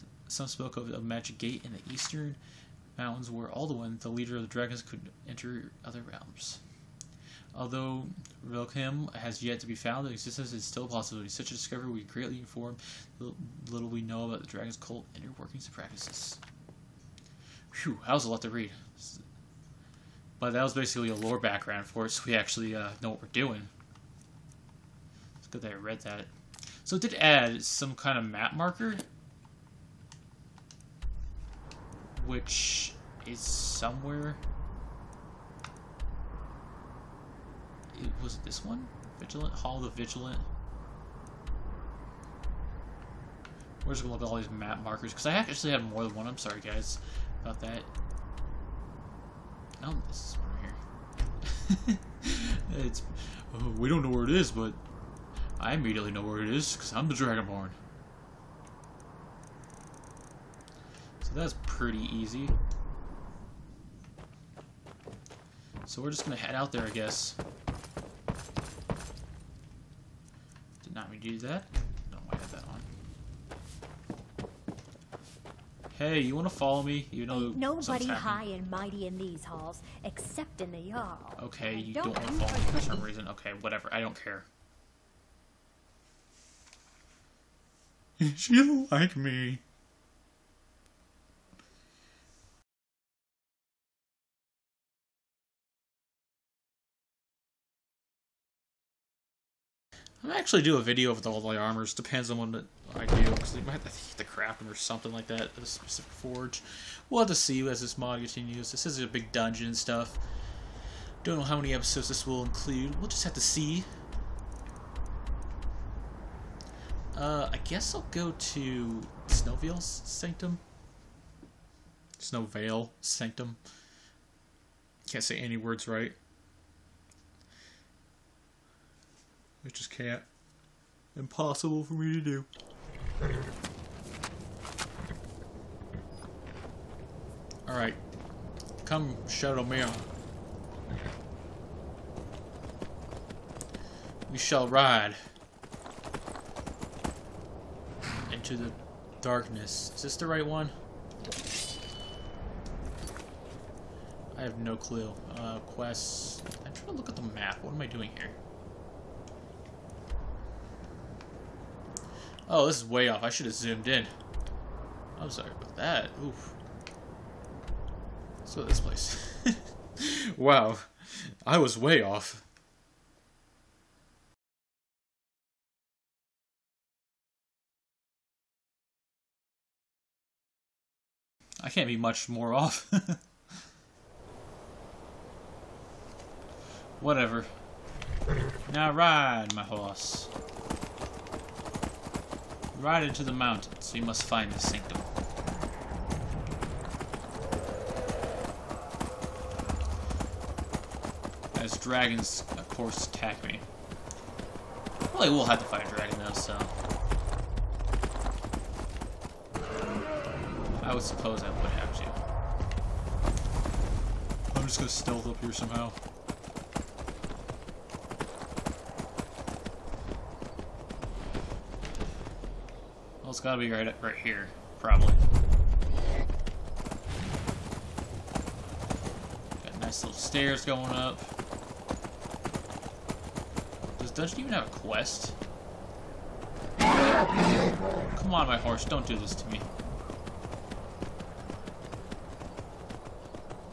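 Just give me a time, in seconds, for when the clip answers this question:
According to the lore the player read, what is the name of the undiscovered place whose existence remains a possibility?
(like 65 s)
8 s.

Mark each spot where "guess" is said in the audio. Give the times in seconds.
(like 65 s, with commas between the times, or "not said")
66 s, 117 s.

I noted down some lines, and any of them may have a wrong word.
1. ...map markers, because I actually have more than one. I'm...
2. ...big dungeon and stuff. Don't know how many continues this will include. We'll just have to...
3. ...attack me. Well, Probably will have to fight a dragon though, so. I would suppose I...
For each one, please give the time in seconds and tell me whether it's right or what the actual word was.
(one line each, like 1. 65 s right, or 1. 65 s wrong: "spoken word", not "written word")
1. 44 s right
2. 109 s wrong: "episodes", not "continues"
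3. 203 s right.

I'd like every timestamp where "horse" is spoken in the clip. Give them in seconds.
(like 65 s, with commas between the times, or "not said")
189 s, 238 s.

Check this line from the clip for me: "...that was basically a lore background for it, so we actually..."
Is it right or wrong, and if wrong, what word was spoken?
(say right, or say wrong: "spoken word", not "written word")
right.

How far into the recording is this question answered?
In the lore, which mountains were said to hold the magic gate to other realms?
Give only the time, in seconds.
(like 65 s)
1 s.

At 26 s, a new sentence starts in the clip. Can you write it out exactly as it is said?
So it did add some kind of map marker which is somewhere.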